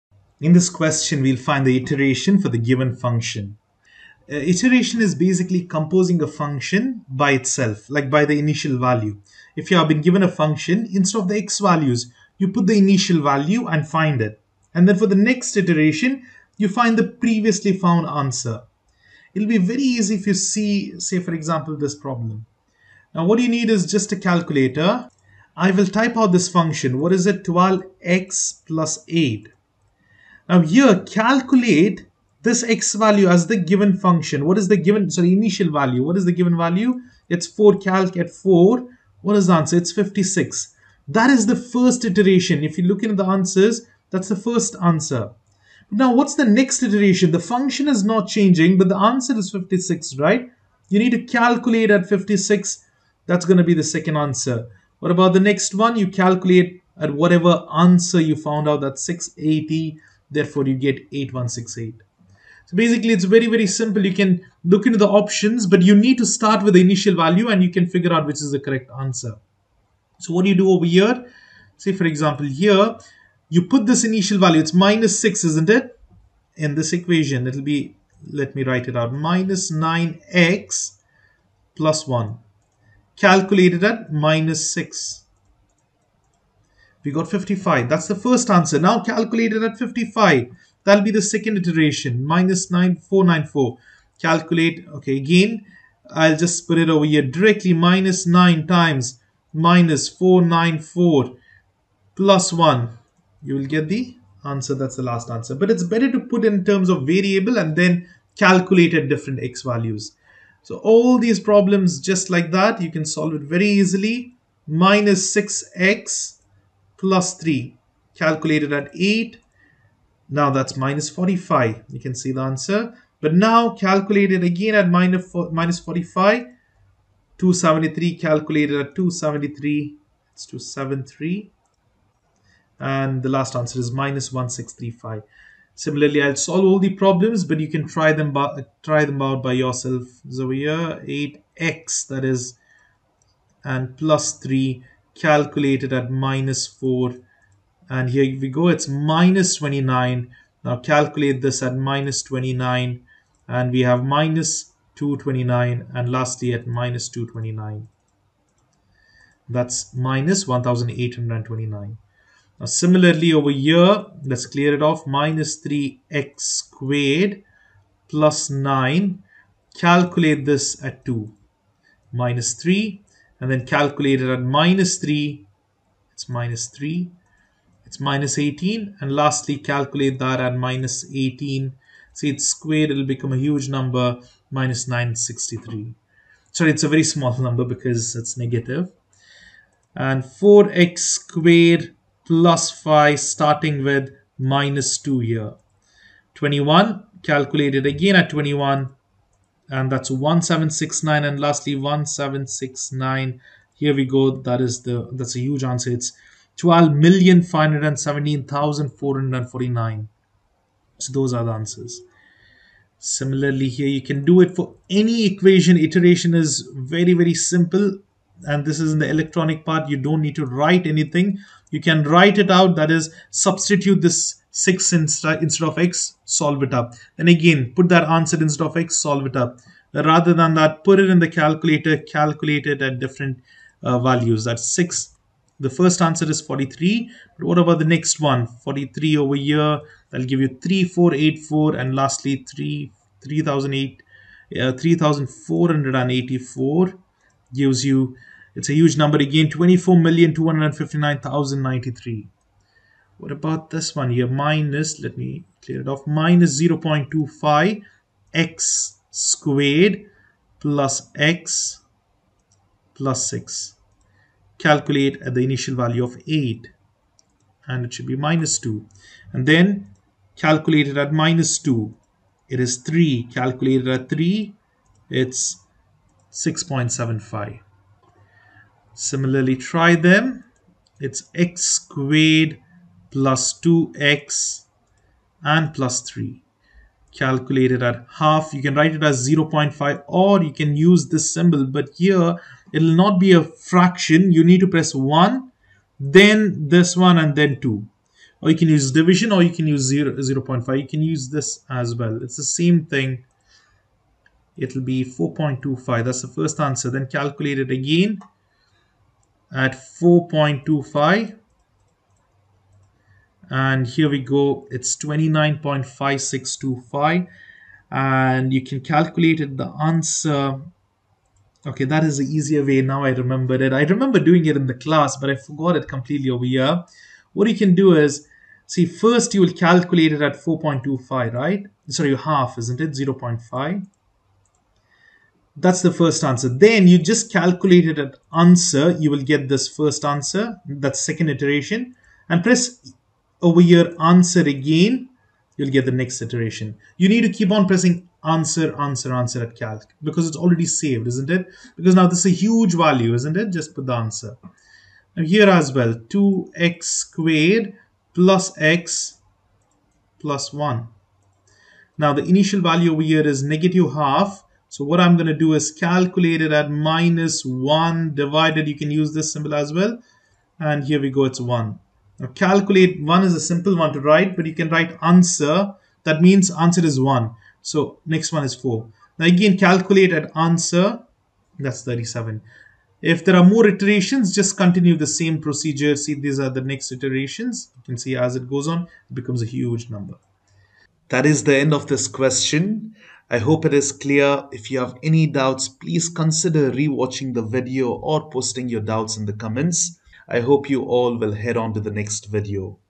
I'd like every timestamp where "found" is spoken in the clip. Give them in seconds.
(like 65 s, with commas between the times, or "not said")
17 s, 58 s.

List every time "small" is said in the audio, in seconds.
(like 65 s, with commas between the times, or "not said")
187 s.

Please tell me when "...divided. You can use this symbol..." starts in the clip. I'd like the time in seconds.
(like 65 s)
368 s.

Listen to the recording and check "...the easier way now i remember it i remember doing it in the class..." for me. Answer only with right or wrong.
right.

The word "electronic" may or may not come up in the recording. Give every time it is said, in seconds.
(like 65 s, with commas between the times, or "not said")
219 s.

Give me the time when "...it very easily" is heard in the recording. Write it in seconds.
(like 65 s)
113 s.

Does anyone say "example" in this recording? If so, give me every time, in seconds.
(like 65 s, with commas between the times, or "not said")
21 s, 72 s.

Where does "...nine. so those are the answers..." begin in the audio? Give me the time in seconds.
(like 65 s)
209 s.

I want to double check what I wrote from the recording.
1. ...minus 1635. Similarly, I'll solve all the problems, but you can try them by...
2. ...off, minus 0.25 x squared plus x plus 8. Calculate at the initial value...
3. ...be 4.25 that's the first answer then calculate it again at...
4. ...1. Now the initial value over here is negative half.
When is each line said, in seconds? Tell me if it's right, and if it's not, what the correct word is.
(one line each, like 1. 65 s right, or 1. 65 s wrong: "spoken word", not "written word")
1. 133 s right
2. 255 s wrong: "6", not "8"
3. 304 s right
4. 360 s right.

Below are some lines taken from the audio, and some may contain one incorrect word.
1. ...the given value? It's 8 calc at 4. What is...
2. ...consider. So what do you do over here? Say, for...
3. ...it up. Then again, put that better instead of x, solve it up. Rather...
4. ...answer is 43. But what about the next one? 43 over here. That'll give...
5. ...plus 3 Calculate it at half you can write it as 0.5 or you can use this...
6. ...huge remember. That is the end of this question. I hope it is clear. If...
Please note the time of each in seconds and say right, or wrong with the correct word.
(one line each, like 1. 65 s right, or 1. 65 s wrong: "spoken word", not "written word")
1. 36 s wrong: "4", not "8"
2. 68 s wrong: "answer", not "consider"
3. 226 s wrong: "answer", not "better"
4. 236 s right
5. 285 s right
6. 389 s wrong: "number", not "remember".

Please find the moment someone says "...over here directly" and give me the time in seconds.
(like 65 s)
96 s.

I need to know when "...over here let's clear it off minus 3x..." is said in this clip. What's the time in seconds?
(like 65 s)
163 s.